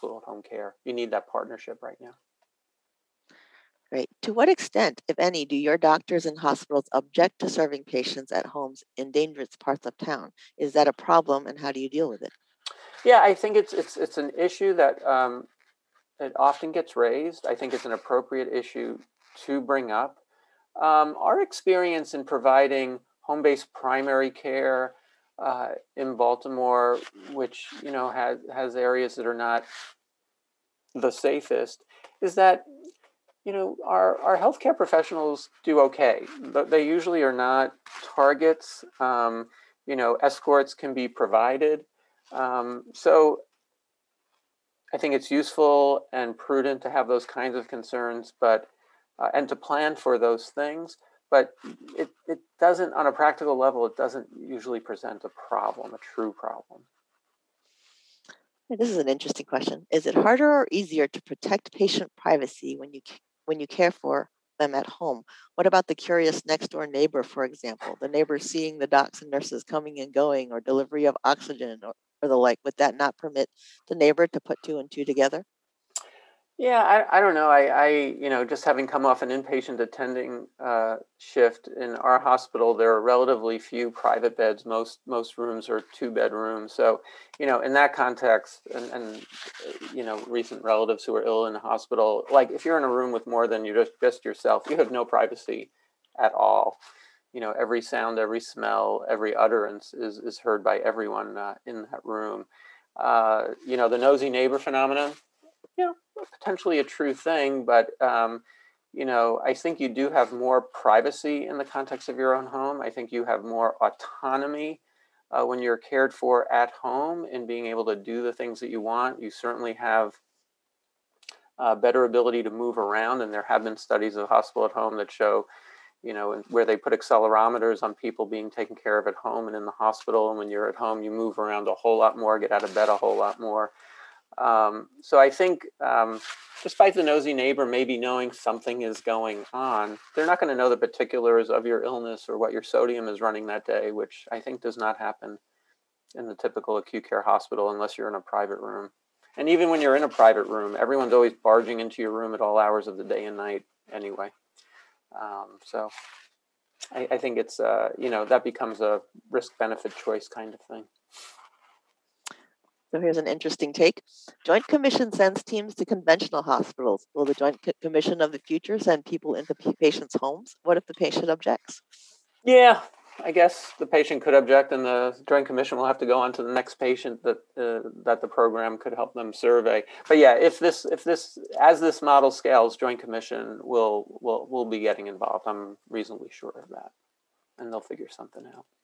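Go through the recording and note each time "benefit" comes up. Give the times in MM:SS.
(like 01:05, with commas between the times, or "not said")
02:39.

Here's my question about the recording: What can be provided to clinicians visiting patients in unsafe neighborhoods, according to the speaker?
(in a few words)
Escorts.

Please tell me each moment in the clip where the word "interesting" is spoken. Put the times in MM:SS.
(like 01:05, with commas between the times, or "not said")
00:59, 02:43.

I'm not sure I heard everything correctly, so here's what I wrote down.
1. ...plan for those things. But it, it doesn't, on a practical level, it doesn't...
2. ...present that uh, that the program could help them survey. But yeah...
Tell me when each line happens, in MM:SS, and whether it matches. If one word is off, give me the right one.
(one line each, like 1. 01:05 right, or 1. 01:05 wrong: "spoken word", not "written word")
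1. 00:49 right
2. 02:56 wrong: "patient", not "present".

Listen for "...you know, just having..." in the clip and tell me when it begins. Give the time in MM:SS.
01:18.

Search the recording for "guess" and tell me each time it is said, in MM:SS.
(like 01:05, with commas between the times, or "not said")
02:53.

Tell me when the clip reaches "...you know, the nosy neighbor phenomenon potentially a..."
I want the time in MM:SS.
01:43.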